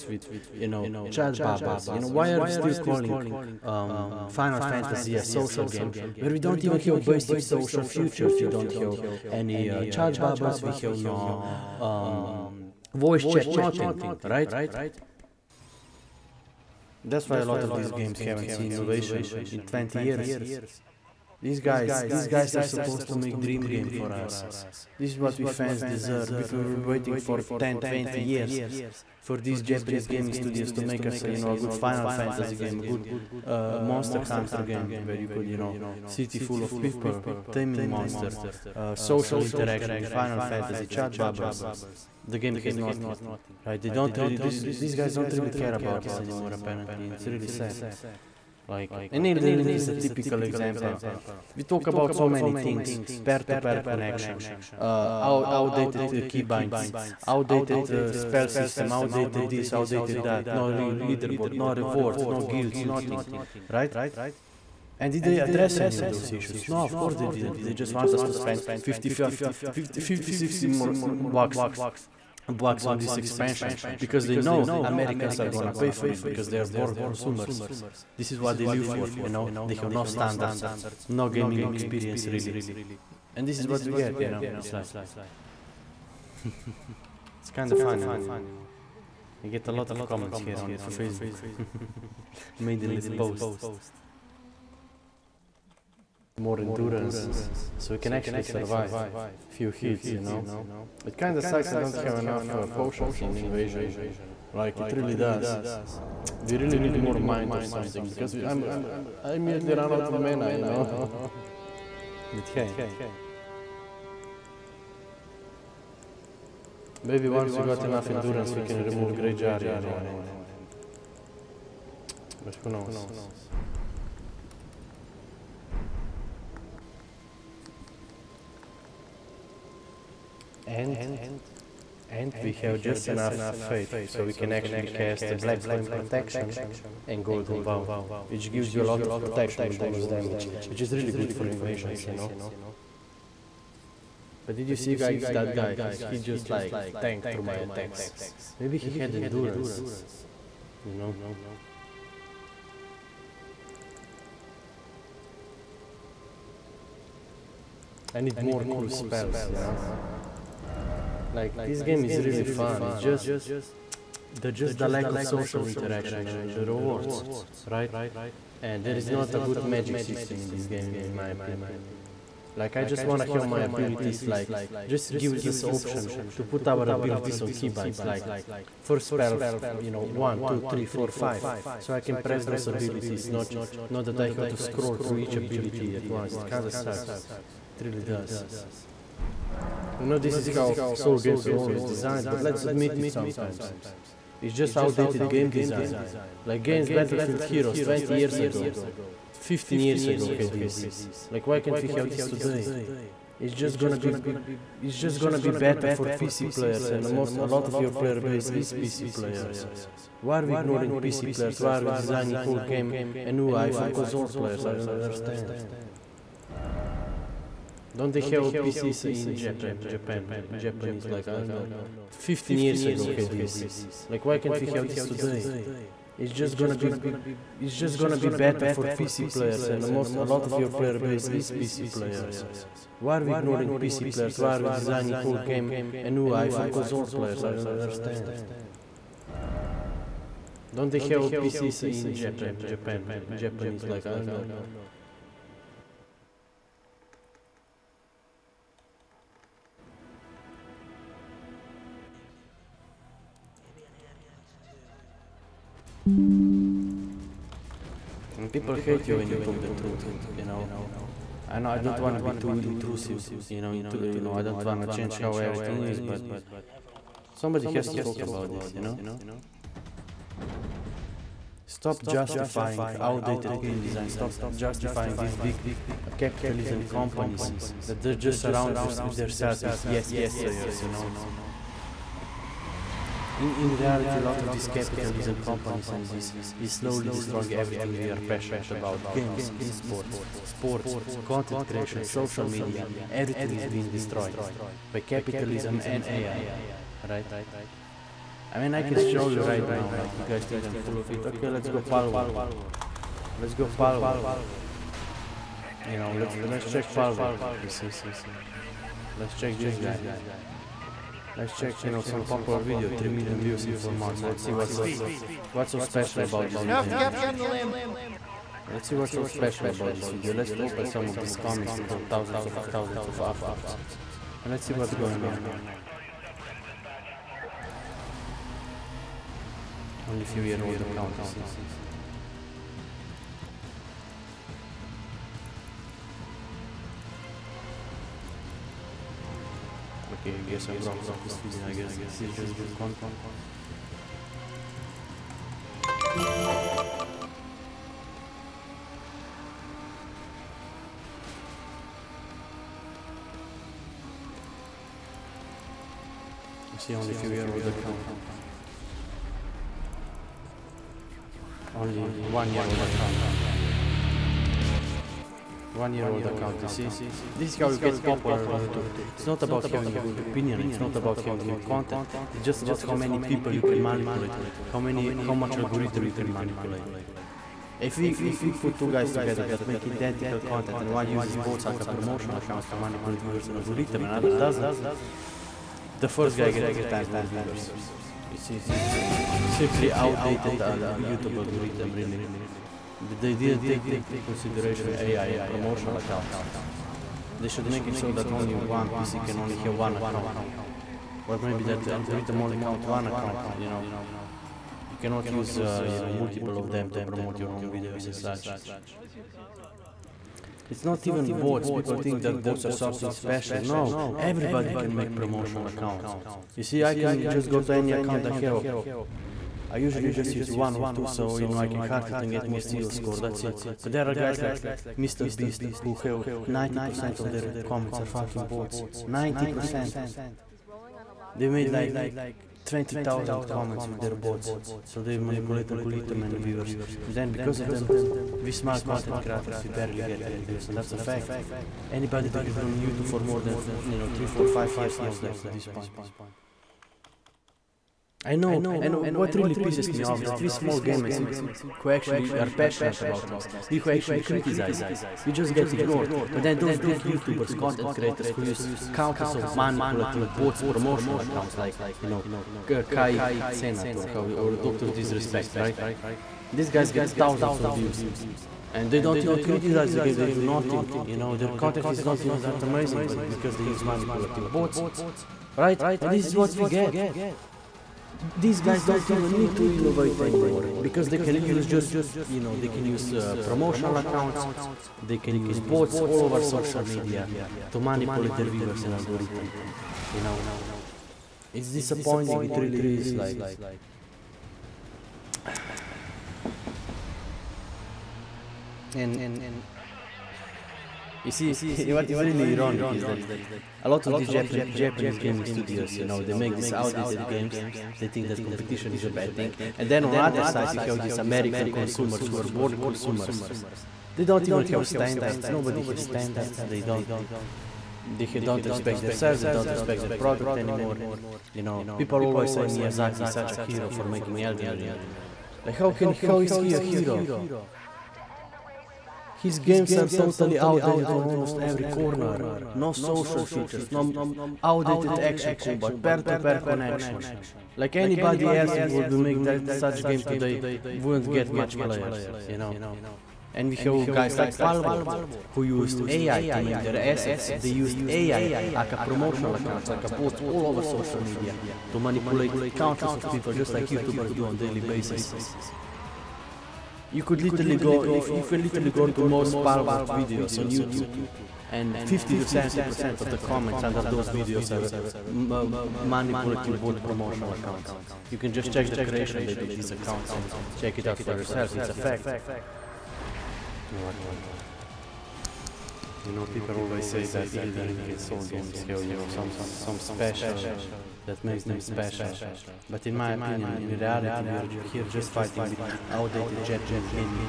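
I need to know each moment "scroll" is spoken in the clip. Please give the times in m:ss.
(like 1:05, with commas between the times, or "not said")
3:04.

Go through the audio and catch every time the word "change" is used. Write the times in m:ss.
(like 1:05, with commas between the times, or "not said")
4:24.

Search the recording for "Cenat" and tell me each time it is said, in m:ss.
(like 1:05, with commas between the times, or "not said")
7:43.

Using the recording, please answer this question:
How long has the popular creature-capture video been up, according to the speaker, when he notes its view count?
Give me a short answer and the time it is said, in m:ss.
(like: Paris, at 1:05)
4 months, at 5:13.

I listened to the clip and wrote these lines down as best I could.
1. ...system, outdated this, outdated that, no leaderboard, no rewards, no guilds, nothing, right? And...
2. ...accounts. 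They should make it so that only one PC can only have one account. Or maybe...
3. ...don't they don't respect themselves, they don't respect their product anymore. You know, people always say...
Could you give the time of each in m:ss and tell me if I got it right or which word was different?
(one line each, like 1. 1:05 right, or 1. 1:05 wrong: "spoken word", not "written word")
1. 0:58 right
2. 6:35 right
3. 8:36 right.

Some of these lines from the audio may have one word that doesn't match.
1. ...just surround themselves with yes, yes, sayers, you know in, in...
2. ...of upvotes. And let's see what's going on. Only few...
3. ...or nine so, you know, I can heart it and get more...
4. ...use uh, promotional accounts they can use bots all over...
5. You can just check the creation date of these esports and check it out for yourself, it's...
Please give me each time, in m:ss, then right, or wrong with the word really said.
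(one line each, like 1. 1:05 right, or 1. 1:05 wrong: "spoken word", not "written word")
1. 4:38 right
2. 5:23 right
3. 7:00 wrong: "two", not "nine"
4. 8:02 right
5. 9:28 wrong: "accounts", not "esports".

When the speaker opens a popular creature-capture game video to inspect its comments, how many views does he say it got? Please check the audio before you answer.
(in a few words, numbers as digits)
3 million.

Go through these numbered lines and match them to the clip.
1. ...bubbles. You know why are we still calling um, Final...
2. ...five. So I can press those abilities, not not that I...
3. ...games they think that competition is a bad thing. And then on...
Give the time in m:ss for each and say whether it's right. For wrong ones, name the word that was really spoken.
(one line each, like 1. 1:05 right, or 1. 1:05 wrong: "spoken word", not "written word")
1. 0:01 right
2. 3:01 right
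3. 8:27 right.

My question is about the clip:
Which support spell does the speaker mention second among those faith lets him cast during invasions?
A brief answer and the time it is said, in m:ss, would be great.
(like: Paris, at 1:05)
Golden Vow, at 2:17.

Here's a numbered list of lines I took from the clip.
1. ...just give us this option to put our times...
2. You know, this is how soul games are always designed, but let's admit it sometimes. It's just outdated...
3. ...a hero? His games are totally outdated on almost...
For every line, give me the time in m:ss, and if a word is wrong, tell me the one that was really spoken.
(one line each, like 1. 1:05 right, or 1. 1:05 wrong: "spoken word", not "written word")
1. 2:54 wrong: "abilities", not "times"
2. 3:09 right
3. 8:46 right.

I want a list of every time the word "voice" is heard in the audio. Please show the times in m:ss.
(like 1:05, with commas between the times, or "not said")
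0:12.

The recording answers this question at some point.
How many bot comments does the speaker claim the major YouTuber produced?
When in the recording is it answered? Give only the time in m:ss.
7:12.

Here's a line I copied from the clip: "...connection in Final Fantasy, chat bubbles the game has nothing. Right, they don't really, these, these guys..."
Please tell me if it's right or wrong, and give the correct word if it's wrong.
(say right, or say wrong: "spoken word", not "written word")
wrong: "interaction", not "connection".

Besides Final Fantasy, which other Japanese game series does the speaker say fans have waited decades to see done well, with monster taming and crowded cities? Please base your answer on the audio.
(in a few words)
Monster Hunter.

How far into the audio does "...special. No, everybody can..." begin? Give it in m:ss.
6:53.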